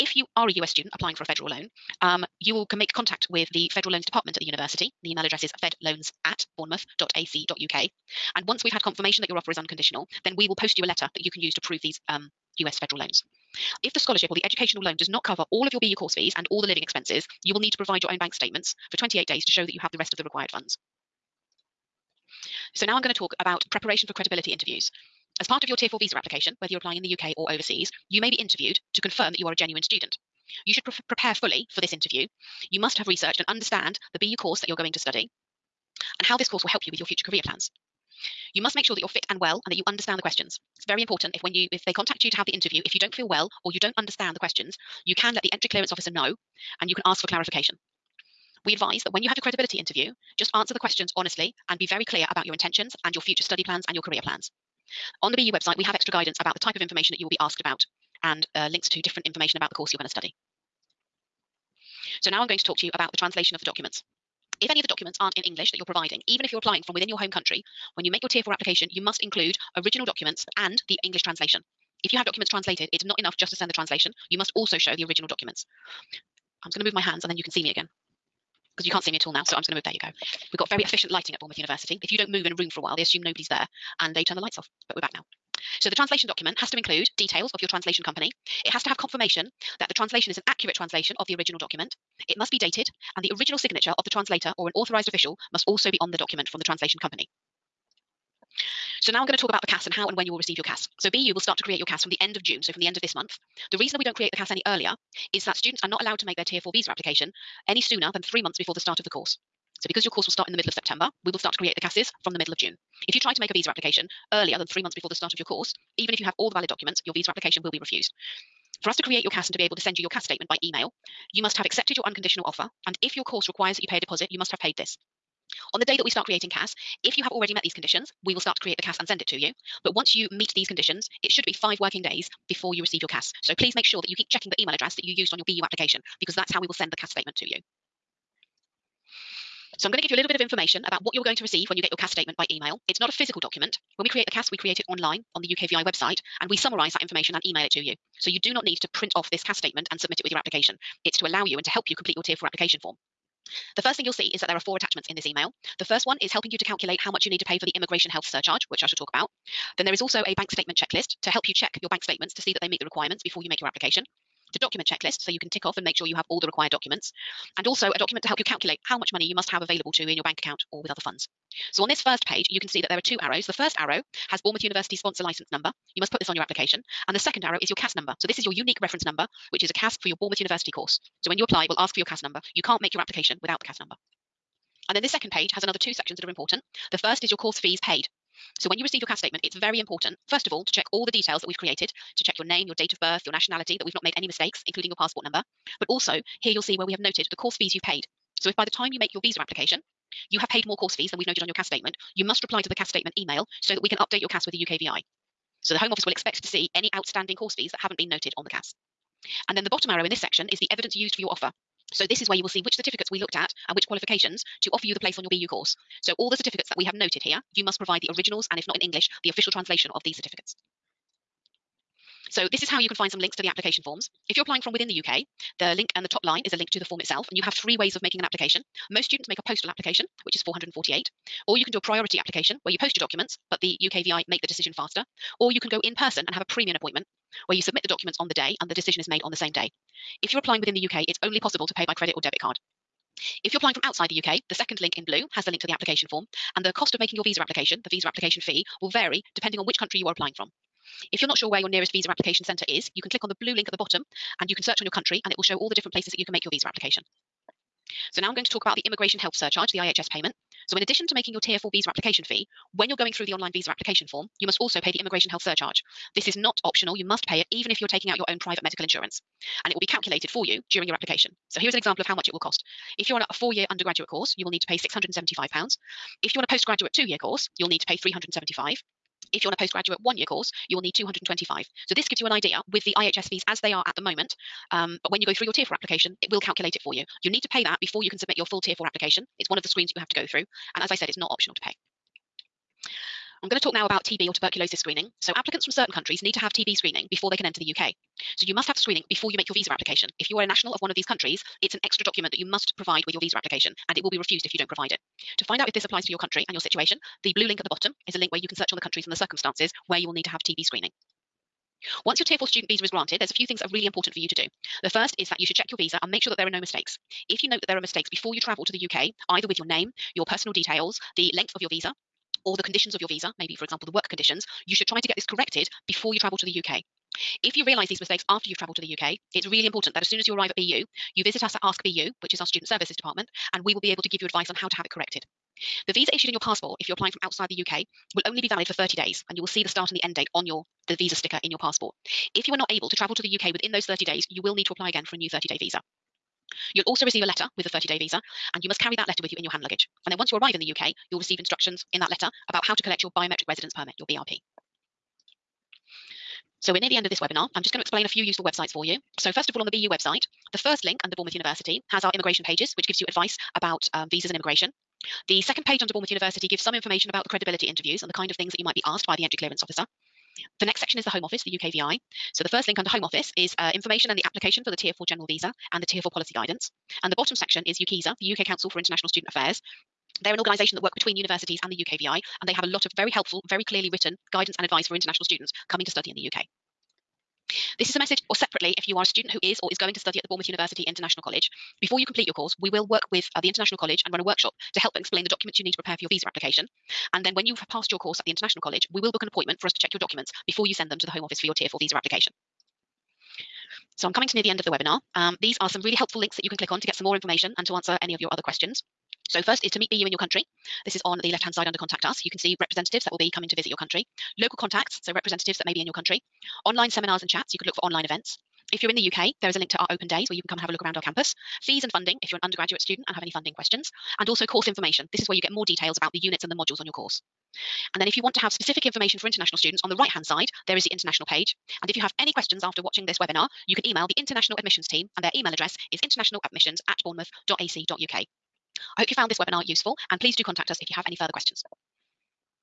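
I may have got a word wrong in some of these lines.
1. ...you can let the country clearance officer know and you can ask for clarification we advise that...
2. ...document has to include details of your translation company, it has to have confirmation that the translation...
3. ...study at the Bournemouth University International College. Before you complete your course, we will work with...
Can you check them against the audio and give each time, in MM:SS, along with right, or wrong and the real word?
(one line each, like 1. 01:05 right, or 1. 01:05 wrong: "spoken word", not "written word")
1. 00:45 wrong: "entry", not "country"
2. 01:26 right
3. 06:29 right.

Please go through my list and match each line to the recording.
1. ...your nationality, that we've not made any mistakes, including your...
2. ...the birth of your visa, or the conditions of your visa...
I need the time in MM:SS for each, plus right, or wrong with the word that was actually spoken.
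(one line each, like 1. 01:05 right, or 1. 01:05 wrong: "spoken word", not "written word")
1. 03:13 right
2. 05:21 wrong: "length", not "birth".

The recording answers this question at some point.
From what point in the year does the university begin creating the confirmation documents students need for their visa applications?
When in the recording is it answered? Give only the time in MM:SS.
01:42.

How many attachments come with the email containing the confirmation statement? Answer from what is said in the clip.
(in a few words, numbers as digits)
4.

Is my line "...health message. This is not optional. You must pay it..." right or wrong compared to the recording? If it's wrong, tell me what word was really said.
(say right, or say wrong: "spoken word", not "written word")
wrong: "surcharge", not "message".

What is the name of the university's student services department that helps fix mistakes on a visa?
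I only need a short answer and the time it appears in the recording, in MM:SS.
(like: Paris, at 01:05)
Ask BU, at 05:31.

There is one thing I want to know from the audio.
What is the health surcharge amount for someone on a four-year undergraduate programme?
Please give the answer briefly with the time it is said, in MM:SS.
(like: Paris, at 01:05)
£675, at 04:34.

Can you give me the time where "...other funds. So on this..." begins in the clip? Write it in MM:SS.
02:50.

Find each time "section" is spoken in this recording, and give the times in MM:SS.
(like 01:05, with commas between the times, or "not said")
03:05, 03:30, 06:10, 06:17.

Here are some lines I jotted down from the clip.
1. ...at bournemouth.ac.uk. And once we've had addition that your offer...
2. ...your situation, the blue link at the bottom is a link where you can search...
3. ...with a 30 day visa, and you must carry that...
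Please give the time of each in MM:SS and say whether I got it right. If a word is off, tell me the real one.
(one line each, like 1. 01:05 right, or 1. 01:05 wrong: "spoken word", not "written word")
1. 00:06 wrong: "confirmation", not "addition"
2. 05:06 right
3. 05:47 right.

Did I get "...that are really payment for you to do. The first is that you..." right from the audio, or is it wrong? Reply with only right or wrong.
wrong.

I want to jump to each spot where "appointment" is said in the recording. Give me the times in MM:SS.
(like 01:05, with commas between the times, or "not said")
03:56, 06:39.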